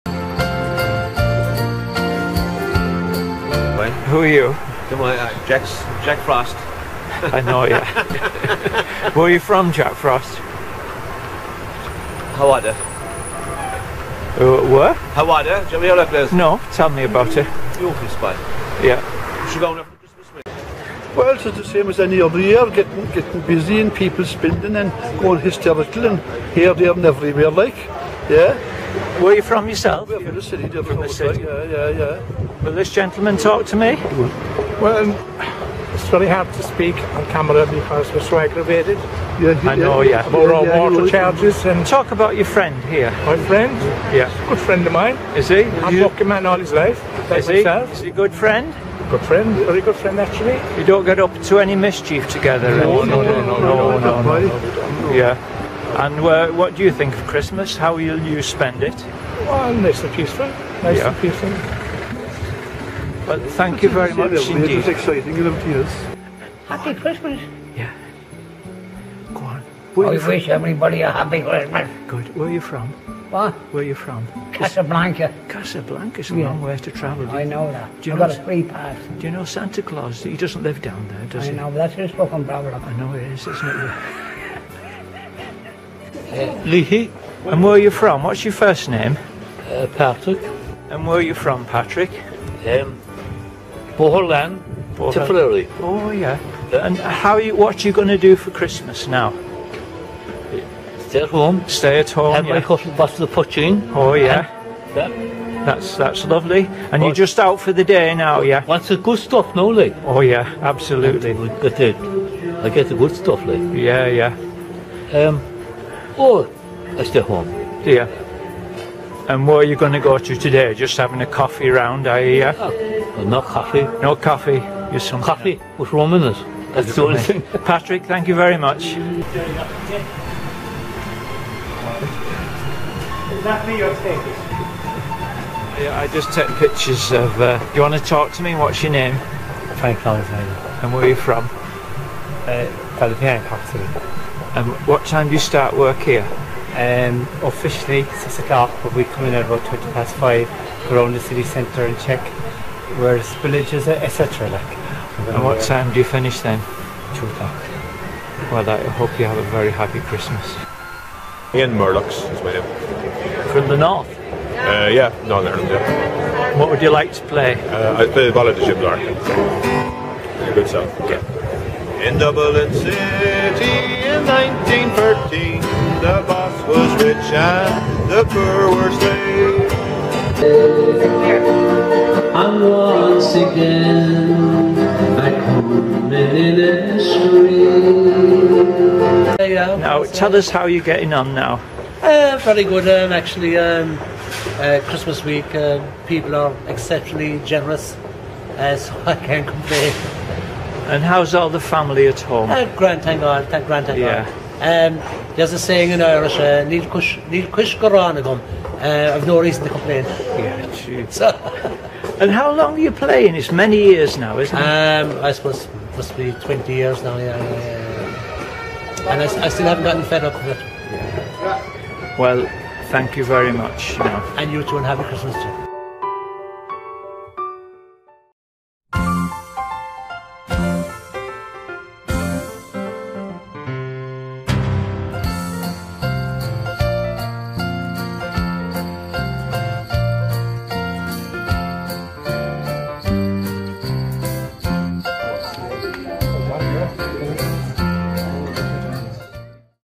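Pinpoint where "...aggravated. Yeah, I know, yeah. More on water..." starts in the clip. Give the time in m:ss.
0:38.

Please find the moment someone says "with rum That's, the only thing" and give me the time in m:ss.
2:05.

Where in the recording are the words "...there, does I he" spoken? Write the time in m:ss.
1:21.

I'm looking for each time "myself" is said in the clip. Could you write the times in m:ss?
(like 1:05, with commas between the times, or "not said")
0:47.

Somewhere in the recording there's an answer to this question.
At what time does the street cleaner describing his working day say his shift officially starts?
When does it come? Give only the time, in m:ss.
2:28.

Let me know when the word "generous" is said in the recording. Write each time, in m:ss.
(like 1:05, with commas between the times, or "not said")
3:17.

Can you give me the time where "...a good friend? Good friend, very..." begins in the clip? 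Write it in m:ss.
0:48.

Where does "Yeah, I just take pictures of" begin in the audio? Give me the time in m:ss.
2:15.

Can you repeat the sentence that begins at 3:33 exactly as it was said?
It's many years now, isn't it?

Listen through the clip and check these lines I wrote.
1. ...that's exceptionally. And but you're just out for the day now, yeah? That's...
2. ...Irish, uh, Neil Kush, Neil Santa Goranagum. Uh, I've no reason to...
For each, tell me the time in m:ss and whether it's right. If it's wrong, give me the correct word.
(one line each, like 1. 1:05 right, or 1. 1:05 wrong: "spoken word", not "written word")
1. 1:45 wrong: "lovely", not "exceptionally"
2. 3:26 wrong: "Kush", not "Santa".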